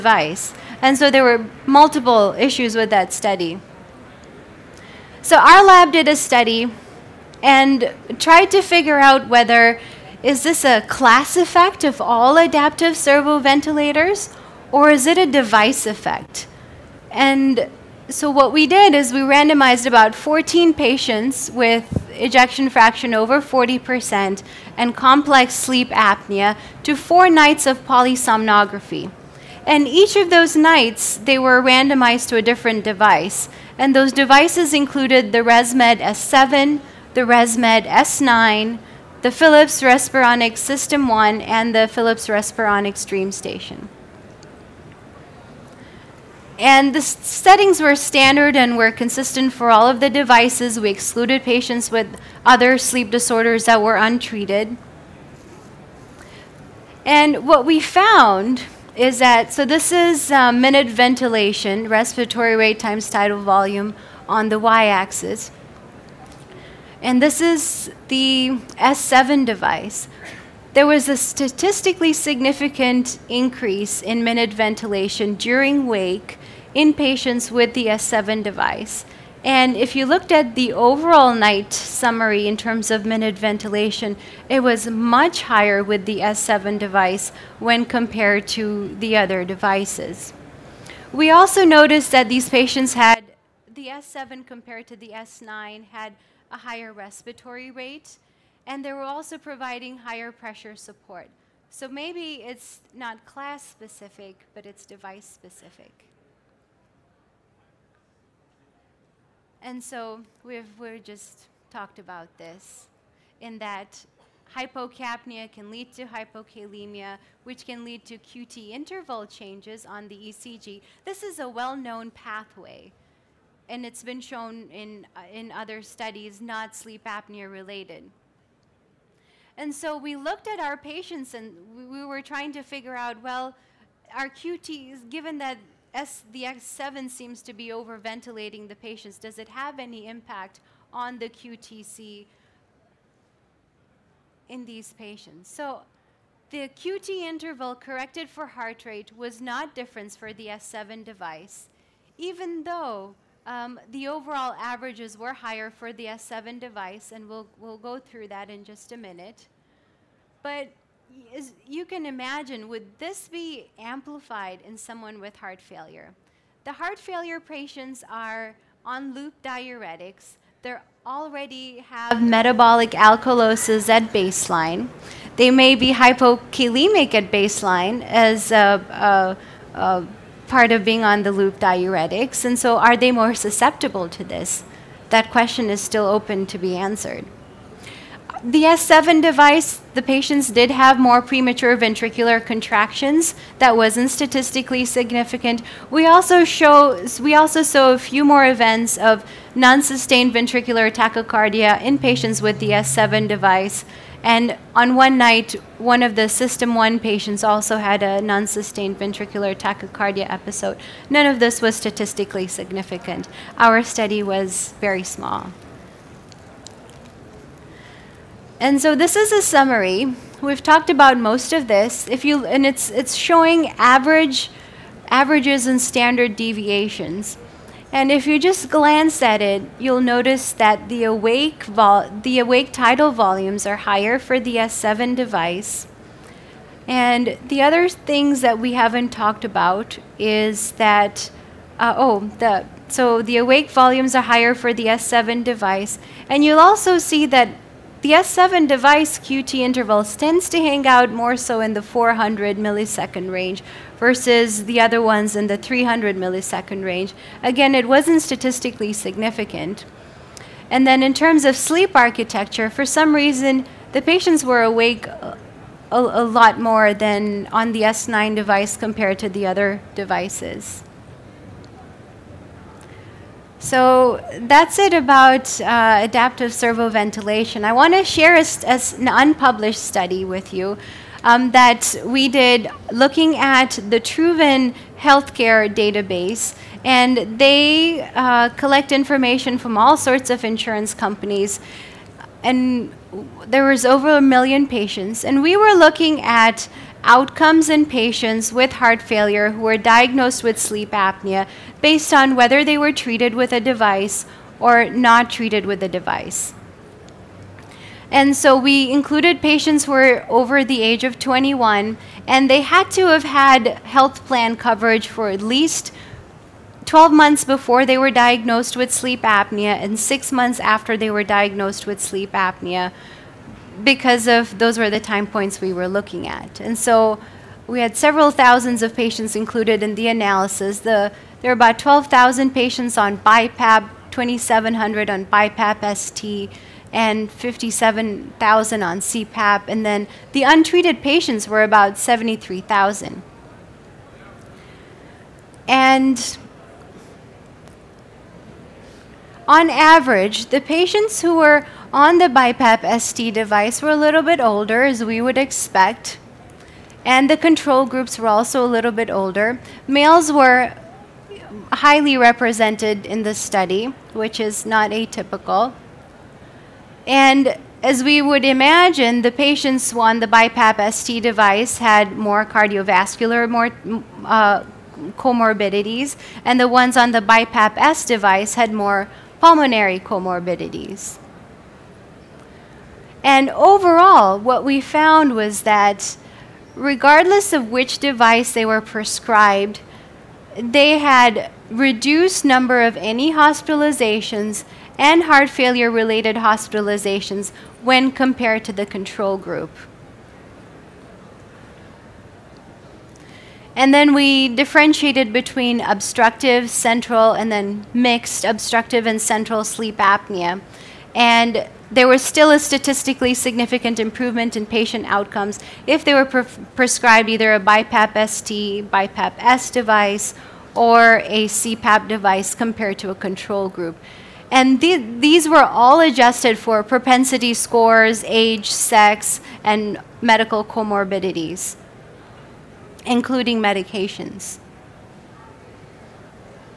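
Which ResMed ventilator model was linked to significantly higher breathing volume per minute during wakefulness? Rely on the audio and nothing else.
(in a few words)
S7.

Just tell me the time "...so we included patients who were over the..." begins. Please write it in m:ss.
5:08.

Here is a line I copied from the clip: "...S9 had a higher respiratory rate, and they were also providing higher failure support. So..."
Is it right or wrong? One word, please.
wrong.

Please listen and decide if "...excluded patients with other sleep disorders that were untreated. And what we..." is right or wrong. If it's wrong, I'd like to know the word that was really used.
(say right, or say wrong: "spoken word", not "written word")
right.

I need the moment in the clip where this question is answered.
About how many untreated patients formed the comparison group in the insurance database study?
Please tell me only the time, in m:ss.
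5:41.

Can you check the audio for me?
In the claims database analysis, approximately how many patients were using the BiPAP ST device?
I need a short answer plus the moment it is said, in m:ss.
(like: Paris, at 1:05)
2,700, at 5:34.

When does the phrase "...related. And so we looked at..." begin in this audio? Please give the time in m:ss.
2:07.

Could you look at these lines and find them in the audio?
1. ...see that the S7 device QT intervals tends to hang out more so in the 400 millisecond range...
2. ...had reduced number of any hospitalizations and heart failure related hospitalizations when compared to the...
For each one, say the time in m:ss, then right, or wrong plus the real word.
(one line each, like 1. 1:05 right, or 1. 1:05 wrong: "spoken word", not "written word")
1. 4:06 right
2. 6:30 right.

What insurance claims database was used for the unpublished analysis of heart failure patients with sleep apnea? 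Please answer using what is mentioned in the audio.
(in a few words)
Truven.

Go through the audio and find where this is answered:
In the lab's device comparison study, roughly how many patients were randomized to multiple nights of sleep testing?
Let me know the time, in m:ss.
0:20.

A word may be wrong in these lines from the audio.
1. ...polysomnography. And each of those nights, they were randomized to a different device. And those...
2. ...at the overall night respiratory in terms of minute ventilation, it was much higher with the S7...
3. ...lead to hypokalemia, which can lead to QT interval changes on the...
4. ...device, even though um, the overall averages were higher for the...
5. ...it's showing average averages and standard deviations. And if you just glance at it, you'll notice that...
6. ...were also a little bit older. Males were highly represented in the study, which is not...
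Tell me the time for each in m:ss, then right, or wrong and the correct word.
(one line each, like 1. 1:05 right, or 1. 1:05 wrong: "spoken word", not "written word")
1. 0:27 right
2. 1:20 wrong: "summary", not "respiratory"
3. 1:55 right
4. 2:31 right
5. 3:42 right
6. 5:58 right.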